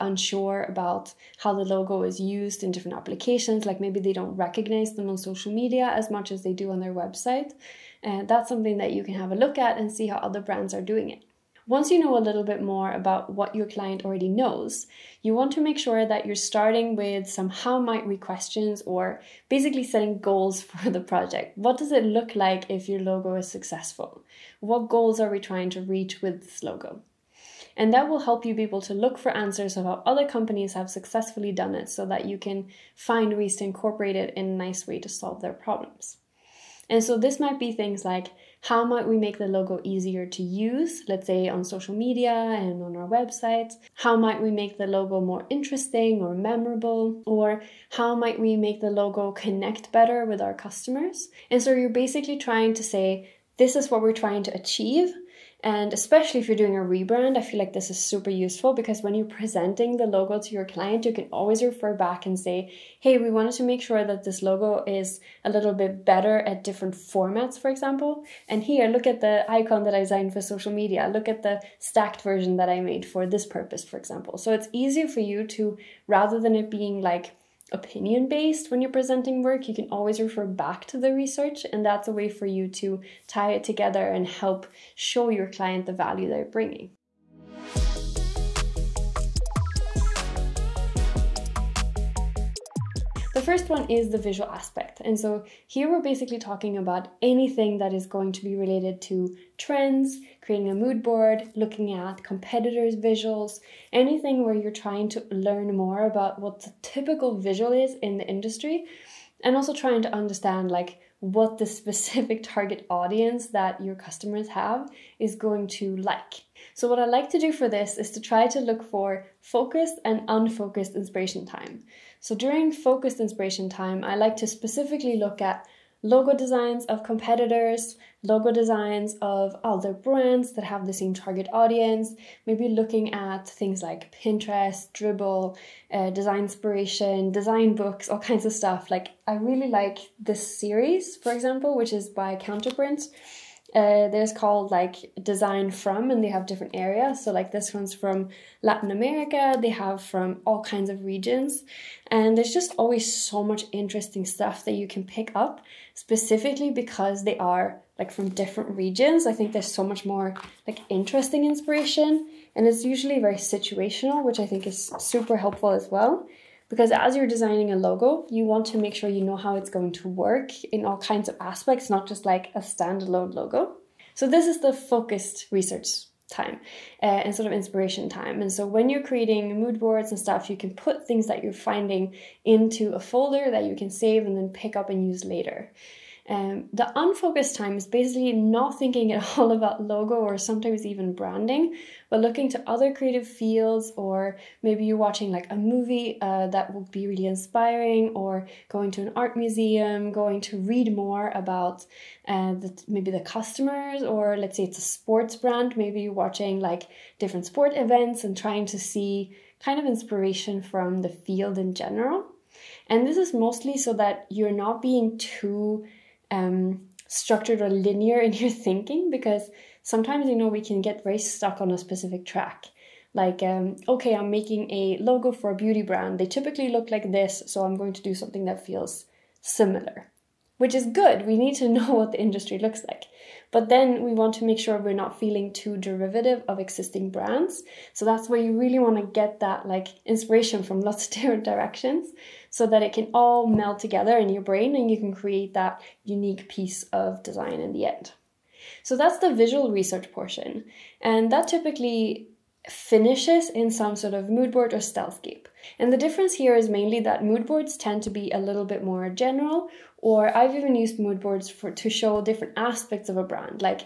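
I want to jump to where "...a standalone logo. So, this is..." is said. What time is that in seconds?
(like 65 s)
172 s.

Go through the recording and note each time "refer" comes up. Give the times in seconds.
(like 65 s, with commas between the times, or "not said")
61 s, 80 s.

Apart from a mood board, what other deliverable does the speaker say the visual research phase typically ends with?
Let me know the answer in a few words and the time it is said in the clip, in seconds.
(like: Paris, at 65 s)
Stylescape, at 254 s.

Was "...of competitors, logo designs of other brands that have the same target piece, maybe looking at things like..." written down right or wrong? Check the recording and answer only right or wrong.
wrong.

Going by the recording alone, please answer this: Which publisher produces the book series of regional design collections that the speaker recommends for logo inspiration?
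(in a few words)
Counterprint.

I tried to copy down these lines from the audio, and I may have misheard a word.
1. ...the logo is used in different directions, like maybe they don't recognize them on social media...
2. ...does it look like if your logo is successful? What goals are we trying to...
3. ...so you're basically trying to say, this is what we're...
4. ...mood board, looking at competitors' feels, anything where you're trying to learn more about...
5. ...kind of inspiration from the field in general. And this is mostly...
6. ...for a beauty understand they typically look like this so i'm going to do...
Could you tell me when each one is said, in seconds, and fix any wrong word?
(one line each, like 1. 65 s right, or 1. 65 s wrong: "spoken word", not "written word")
1. 1 s wrong: "applications", not "directions"
2. 21 s right
3. 51 s right
4. 100 s wrong: "visuals", not "feels"
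5. 209 s right
6. 225 s wrong: "brand", not "understand".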